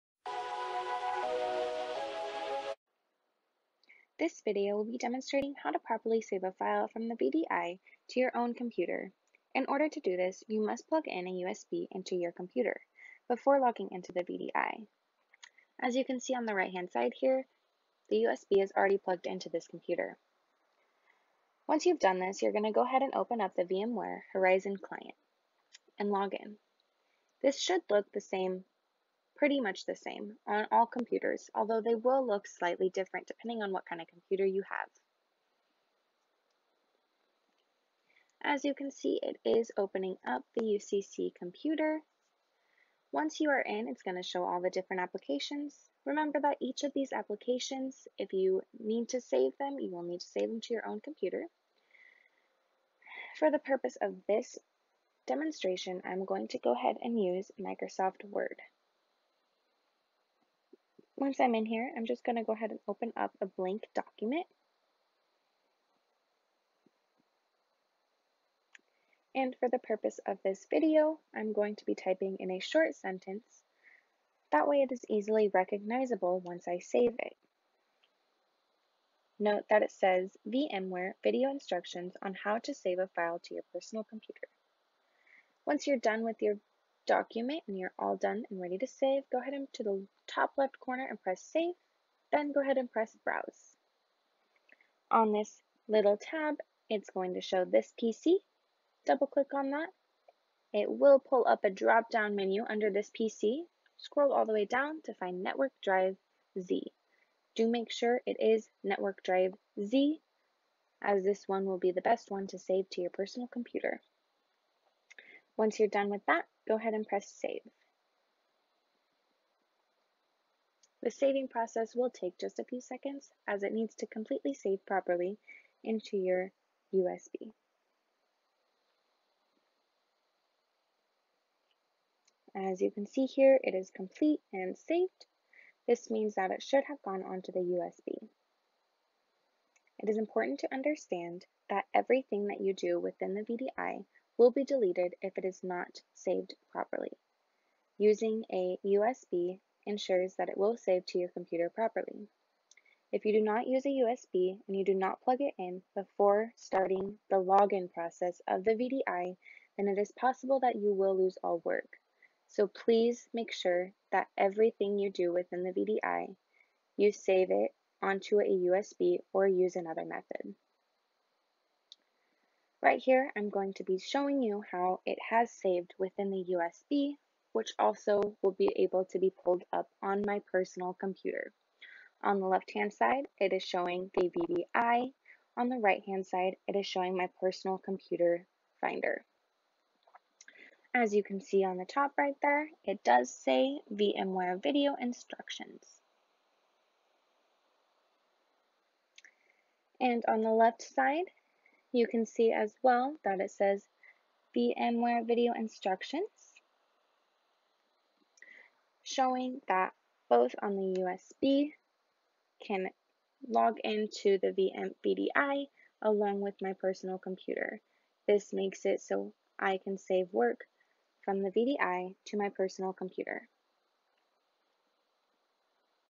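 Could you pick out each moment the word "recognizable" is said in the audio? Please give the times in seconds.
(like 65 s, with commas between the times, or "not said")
75 s.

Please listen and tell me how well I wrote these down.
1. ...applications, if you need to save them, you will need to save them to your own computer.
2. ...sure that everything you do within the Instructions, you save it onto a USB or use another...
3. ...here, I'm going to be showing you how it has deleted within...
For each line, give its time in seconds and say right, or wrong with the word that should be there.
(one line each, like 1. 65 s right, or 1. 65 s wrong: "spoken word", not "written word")
1. 47 s right
2. 163 s wrong: "VDI", not "Instructions"
3. 172 s wrong: "saved", not "deleted".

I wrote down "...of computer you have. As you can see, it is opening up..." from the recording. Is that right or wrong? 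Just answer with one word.
right.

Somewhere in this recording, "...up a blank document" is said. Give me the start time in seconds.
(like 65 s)
63 s.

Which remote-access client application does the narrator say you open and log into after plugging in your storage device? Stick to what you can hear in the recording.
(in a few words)
VMware Horizon.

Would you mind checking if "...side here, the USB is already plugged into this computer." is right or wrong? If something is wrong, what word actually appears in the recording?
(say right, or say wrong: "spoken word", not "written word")
right.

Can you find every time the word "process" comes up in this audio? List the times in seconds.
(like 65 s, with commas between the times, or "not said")
121 s, 157 s.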